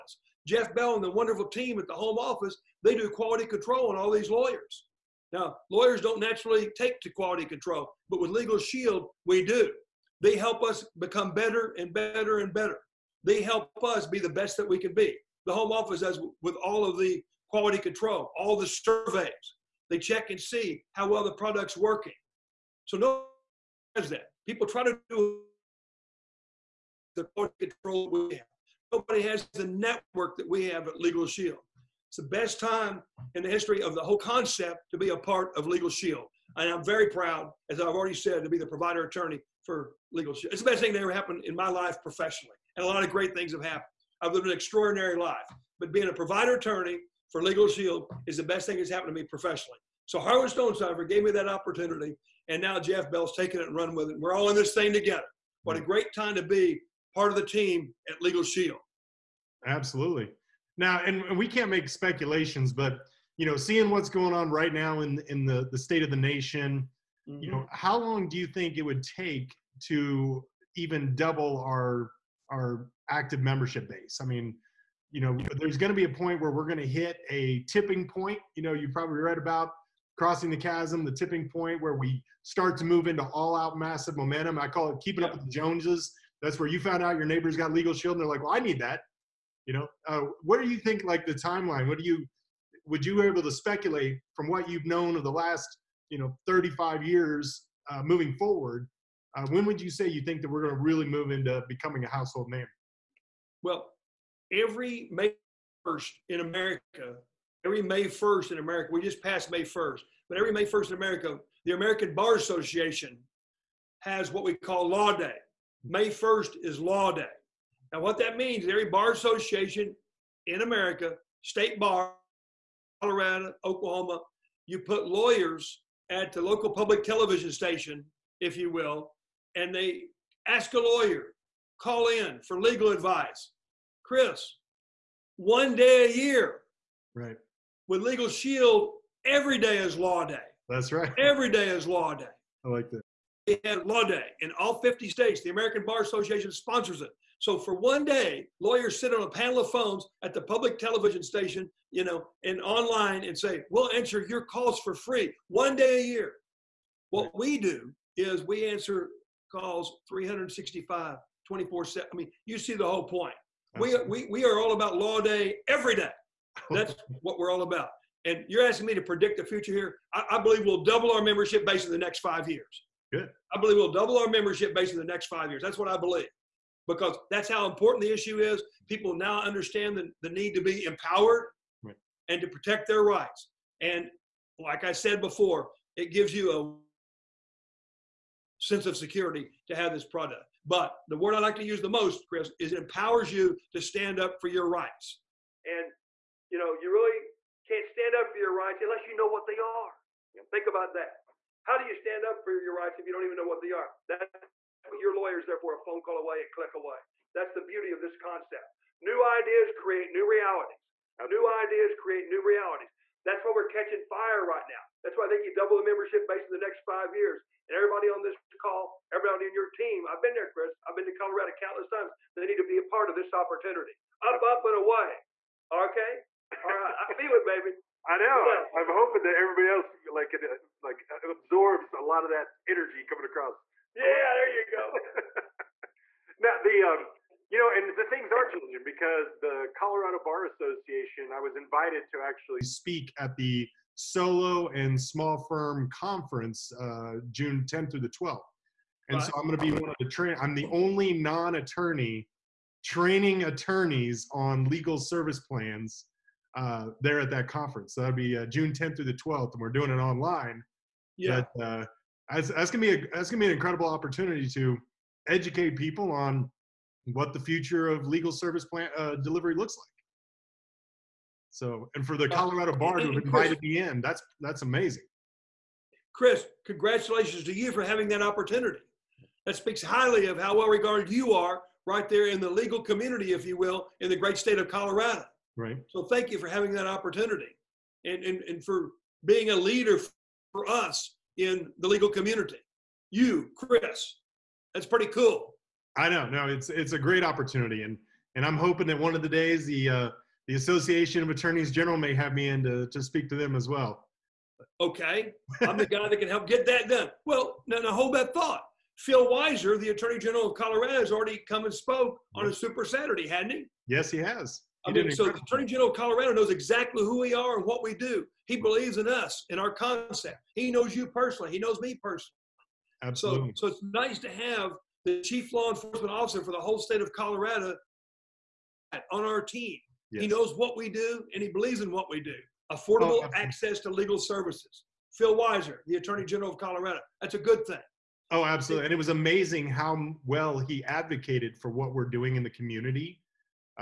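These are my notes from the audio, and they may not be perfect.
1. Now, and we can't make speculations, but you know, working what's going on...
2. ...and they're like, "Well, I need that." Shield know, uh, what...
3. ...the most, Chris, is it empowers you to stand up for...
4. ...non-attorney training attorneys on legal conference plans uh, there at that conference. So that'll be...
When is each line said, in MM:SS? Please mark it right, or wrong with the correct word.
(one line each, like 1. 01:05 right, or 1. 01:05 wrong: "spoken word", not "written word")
1. 01:00 wrong: "seeing", not "working"
2. 01:28 wrong: "You", not "Shield"
3. 03:11 right
4. 04:11 wrong: "service", not "conference".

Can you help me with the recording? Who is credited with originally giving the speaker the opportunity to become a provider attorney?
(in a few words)
Harlan Stonecipher.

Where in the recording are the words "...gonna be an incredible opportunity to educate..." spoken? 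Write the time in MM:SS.
04:23.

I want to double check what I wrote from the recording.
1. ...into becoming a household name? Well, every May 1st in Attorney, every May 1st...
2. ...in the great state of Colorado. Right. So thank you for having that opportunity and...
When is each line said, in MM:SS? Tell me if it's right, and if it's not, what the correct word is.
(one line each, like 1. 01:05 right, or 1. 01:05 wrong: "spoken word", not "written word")
1. 01:41 wrong: "America", not "Attorney"
2. 04:44 right.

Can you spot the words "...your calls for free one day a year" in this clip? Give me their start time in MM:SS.
02:34.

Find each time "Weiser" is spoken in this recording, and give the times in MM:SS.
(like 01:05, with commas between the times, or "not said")
05:09, 05:35.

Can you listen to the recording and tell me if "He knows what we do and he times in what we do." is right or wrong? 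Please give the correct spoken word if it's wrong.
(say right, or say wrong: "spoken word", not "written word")
wrong: "believes", not "times".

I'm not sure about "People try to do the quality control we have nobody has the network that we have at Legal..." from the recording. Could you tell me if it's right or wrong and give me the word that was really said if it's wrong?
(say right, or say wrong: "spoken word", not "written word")
right.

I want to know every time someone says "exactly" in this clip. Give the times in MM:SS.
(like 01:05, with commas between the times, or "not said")
05:16.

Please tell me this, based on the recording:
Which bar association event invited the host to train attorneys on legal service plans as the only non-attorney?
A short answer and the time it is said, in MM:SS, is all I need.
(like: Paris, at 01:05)
Solo and Small Firm Conference, at 04:03.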